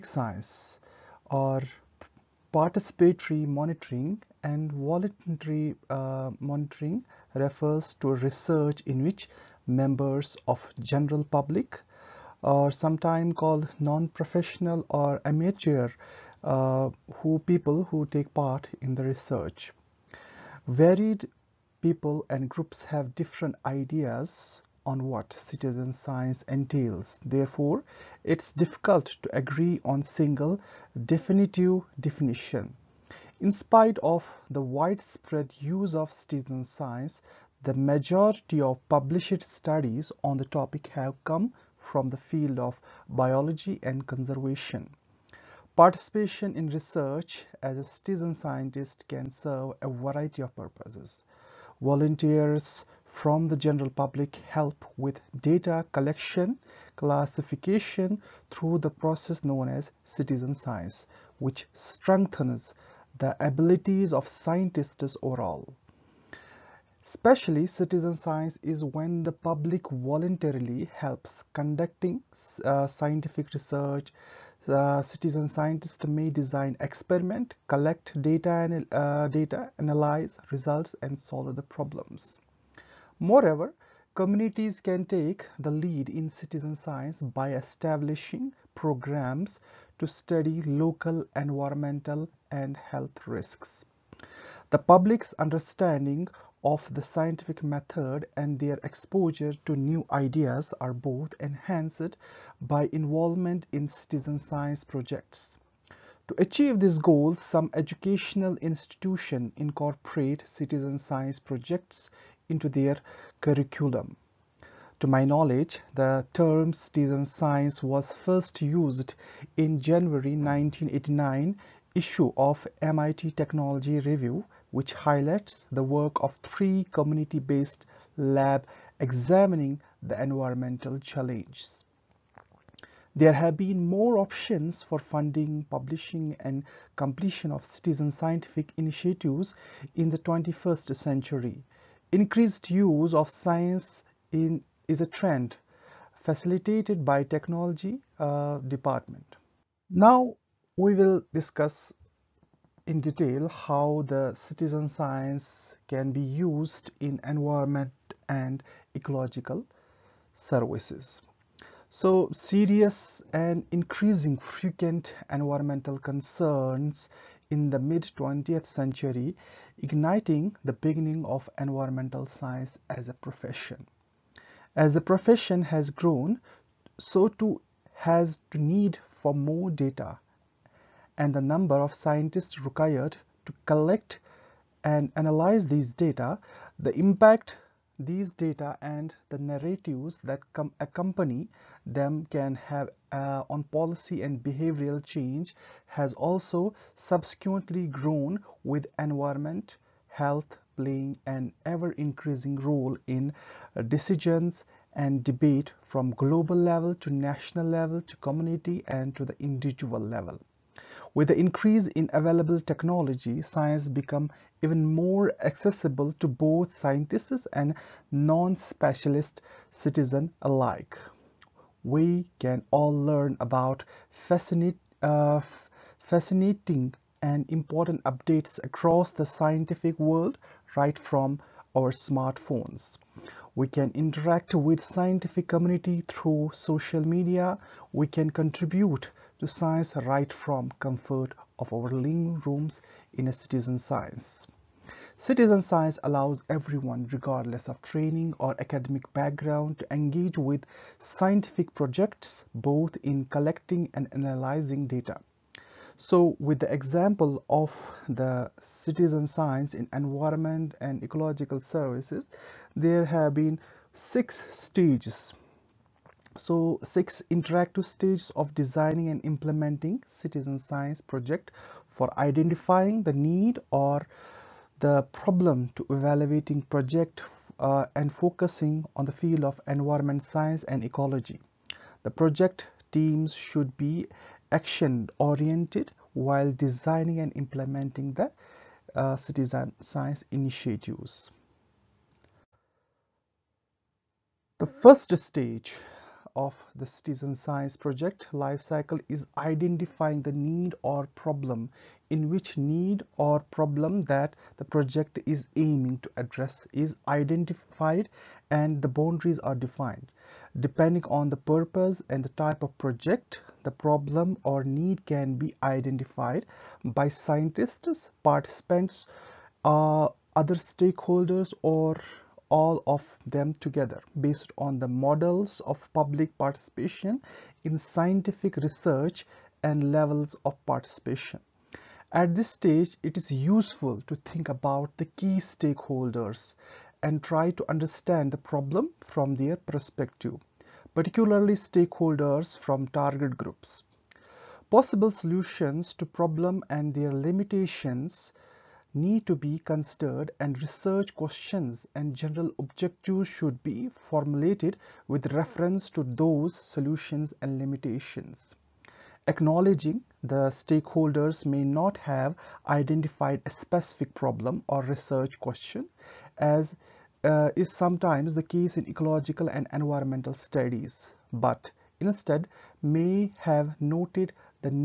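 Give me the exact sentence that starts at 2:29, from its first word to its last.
Now we will discuss in detail how the citizen science can be used in environment and ecological services.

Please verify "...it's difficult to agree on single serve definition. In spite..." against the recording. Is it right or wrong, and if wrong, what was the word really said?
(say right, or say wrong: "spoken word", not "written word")
wrong: "definitive", not "serve".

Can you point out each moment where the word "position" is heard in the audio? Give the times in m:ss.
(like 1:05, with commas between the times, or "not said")
not said.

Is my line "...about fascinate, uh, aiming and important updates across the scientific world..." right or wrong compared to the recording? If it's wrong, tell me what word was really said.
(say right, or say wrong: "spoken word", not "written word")
wrong: "fascinating", not "aiming".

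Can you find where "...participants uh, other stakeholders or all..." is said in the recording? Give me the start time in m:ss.
5:18.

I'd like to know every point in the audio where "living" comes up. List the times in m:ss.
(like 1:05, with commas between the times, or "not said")
4:01.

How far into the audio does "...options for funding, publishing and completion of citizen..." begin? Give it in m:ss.
2:14.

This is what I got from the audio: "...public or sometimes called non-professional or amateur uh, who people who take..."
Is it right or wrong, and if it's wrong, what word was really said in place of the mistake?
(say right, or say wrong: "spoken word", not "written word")
right.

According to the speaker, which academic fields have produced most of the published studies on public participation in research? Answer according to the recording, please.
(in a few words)
biology and conservation.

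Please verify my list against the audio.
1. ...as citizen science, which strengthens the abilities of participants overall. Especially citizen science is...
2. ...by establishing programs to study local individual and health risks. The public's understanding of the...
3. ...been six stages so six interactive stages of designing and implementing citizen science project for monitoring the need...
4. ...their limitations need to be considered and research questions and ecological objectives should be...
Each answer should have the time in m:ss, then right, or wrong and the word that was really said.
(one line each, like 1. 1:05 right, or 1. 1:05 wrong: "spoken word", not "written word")
1. 0:59 wrong: "scientists", not "participants"
2. 1:27 wrong: "environmental", not "individual"
3. 4:23 wrong: "identifying", not "monitoring"
4. 5:46 wrong: "general", not "ecological".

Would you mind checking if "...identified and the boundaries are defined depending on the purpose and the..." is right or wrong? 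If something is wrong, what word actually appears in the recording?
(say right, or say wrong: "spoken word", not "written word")
right.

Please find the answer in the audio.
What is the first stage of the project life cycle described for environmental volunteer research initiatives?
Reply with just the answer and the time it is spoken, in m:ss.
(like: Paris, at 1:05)
identifying the need or problem, at 4:59.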